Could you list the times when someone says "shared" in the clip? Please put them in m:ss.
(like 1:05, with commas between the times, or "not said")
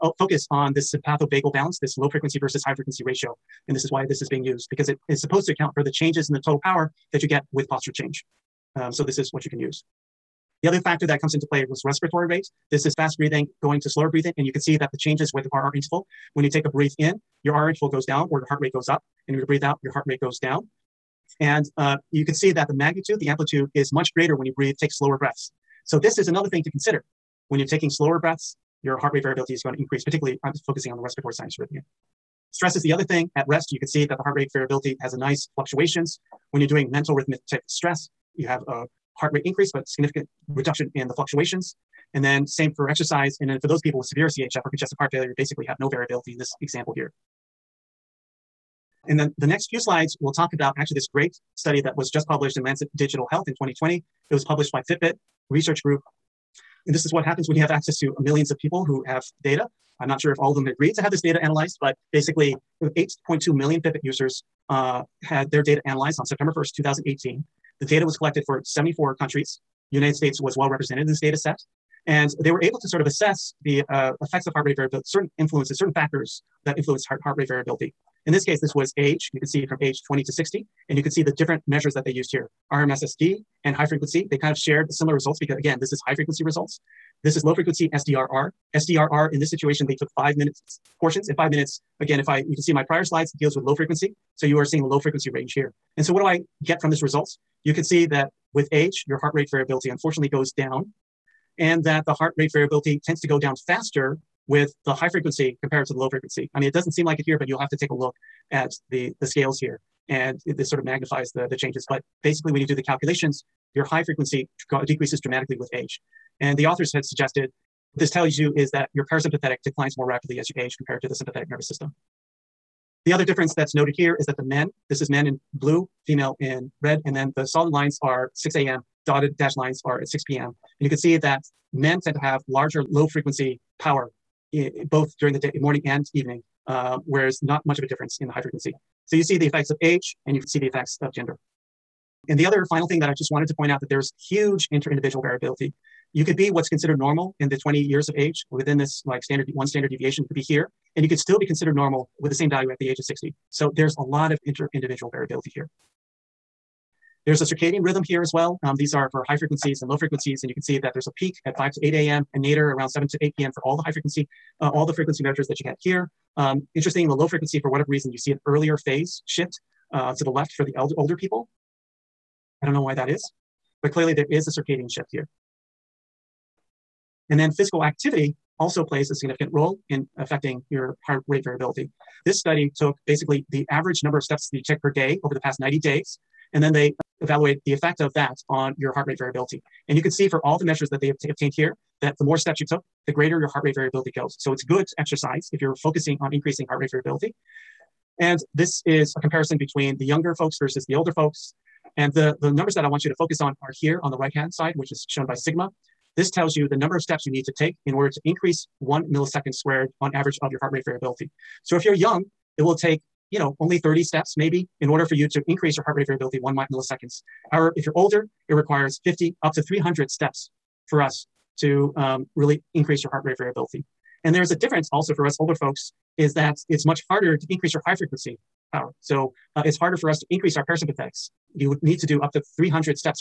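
1:24.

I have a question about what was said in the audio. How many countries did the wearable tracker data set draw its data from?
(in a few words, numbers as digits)
74.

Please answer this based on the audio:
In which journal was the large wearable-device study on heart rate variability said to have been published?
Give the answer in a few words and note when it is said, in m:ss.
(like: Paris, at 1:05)
Lancet Digital Health, at 0:52.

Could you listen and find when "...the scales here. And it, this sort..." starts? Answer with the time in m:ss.
1:49.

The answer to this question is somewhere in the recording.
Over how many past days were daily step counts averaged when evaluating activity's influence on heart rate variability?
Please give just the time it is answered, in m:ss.
3:05.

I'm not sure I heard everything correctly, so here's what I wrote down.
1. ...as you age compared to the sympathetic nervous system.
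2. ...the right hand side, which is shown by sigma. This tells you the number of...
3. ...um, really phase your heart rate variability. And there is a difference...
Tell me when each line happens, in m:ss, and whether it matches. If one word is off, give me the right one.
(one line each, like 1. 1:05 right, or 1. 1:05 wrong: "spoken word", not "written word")
1. 2:00 right
2. 3:24 right
3. 3:41 wrong: "increase", not "phase".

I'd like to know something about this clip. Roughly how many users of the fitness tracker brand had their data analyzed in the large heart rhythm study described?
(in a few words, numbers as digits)
8.2 million.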